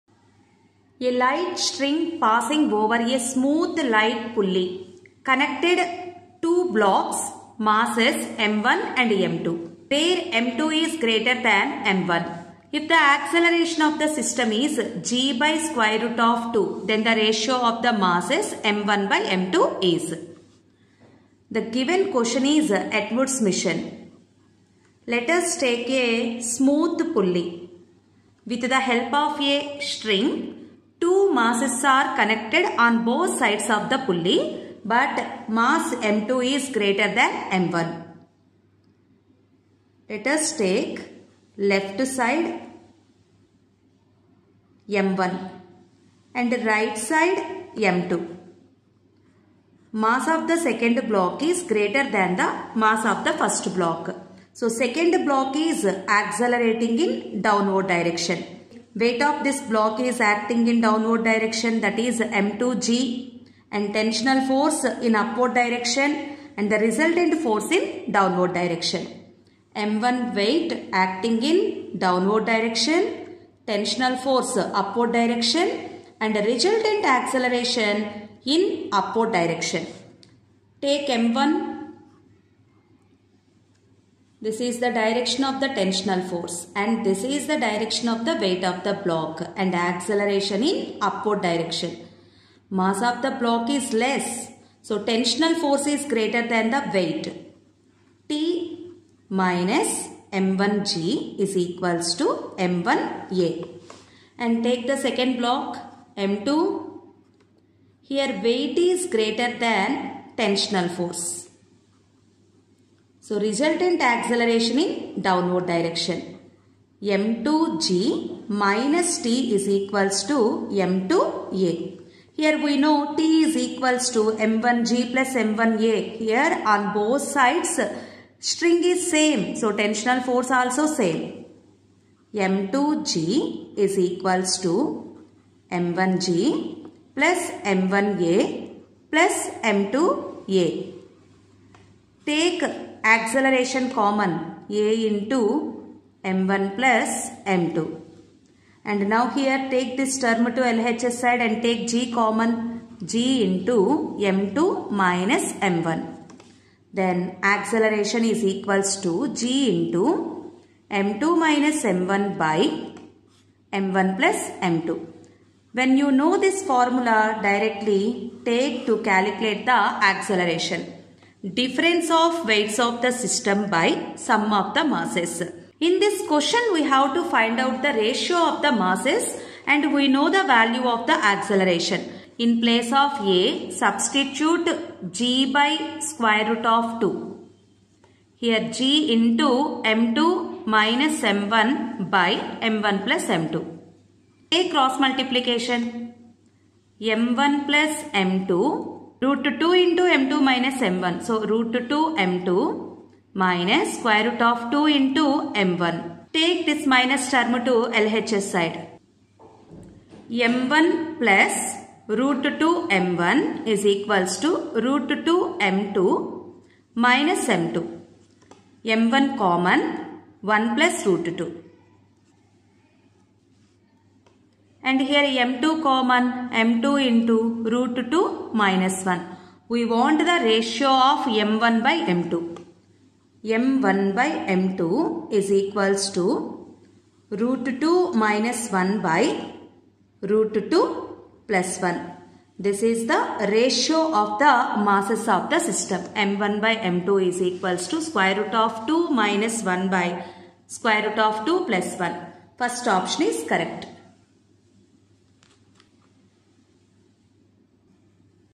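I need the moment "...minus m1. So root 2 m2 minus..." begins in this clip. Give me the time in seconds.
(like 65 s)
200 s.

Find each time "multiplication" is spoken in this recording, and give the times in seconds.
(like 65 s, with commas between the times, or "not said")
194 s.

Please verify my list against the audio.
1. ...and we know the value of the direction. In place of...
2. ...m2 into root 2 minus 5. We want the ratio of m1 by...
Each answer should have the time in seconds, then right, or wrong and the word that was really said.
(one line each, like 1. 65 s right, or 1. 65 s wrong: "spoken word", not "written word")
1. 179 s wrong: "acceleration", not "direction"
2. 226 s wrong: "1", not "5".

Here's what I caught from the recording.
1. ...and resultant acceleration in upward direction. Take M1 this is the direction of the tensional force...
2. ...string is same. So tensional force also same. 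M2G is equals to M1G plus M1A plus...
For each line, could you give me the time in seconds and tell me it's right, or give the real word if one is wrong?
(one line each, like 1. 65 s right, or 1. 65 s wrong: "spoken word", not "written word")
1. 76 s right
2. 128 s right.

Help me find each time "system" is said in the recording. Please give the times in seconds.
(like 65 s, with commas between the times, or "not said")
14 s, 173 s, 245 s.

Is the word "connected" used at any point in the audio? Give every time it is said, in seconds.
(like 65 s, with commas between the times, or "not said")
5 s, 32 s.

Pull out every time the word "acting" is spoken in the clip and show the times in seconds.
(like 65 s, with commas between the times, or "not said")
60 s, 70 s.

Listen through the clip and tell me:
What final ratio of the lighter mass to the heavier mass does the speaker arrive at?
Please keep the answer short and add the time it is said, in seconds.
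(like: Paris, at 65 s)
(√2 − 1)/(√2 + 1), at 237 s.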